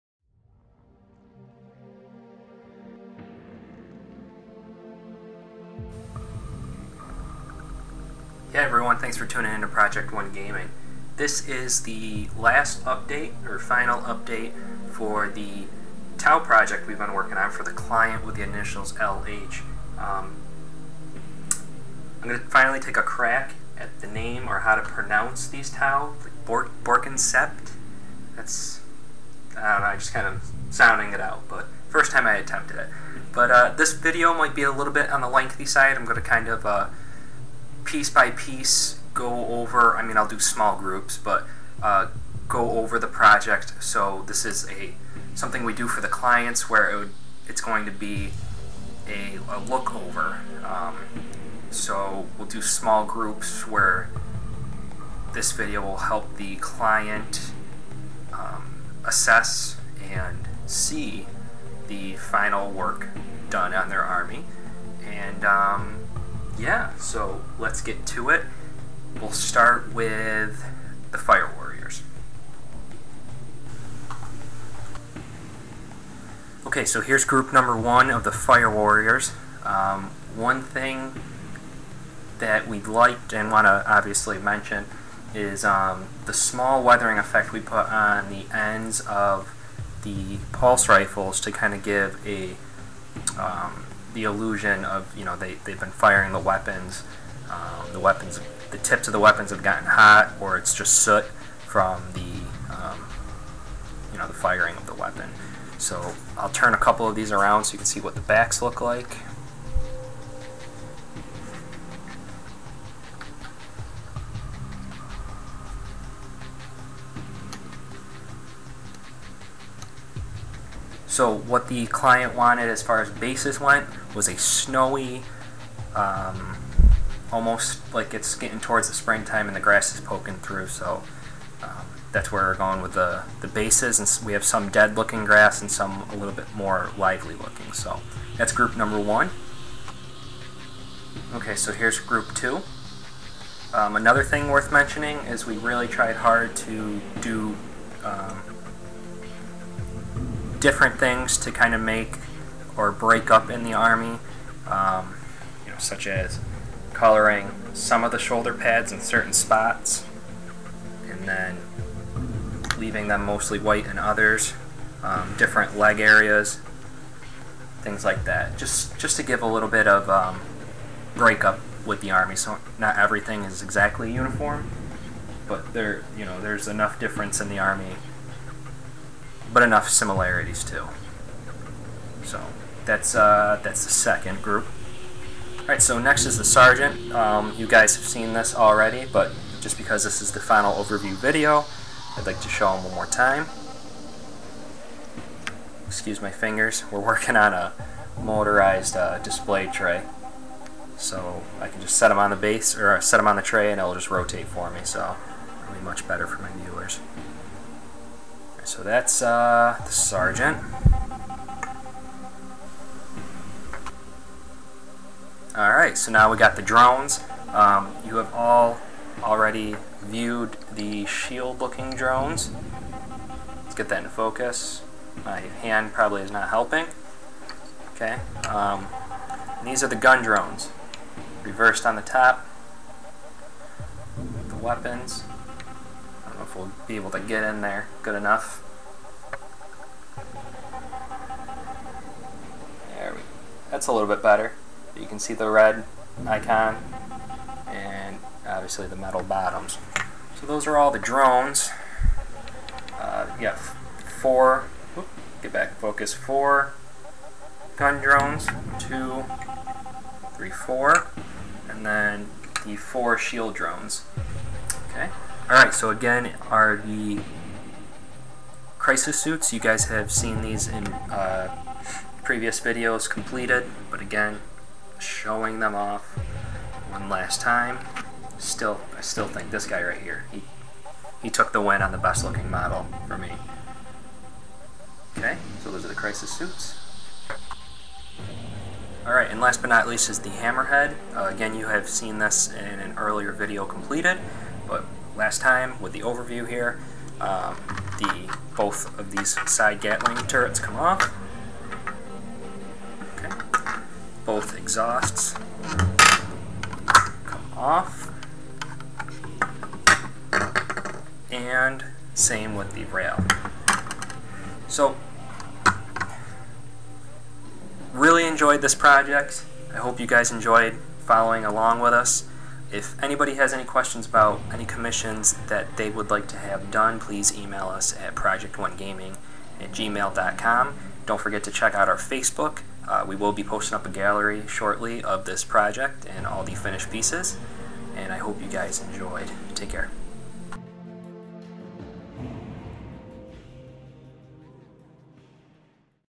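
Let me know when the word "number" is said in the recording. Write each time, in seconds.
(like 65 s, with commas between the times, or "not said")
77 s, 138 s.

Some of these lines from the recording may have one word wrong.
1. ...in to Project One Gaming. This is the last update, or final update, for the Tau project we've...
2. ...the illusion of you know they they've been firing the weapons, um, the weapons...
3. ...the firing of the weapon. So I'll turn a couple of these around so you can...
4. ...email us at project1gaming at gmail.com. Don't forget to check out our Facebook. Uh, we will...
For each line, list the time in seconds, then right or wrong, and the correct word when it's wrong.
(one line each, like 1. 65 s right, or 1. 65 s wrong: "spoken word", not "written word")
1. 9 s right
2. 94 s right
3. 104 s right
4. 327 s right.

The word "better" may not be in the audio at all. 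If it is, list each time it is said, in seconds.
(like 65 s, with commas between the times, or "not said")
206 s, 244 s.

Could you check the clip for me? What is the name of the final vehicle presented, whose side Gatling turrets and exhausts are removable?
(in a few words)
Hammerhead.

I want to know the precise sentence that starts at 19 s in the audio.
Um, I'm going to finally take a crack at the name or how to pronounce these Tau, like Bor Bork'an Sept.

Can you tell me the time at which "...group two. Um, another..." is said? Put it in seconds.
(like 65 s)
141 s.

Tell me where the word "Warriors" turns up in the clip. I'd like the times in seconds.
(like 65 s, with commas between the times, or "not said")
71 s, 78 s.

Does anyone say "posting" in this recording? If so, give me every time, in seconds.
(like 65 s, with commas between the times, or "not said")
333 s.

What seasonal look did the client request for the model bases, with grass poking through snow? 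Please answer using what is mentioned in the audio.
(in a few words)
springtime.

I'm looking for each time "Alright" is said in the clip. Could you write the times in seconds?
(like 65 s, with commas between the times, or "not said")
215 s, 265 s, 289 s.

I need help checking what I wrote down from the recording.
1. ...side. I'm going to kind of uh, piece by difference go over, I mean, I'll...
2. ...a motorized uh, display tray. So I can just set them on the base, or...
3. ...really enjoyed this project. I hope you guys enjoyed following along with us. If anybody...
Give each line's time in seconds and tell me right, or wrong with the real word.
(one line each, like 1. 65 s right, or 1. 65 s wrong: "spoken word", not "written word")
1. 35 s wrong: "piece", not "difference"
2. 197 s right
3. 317 s right.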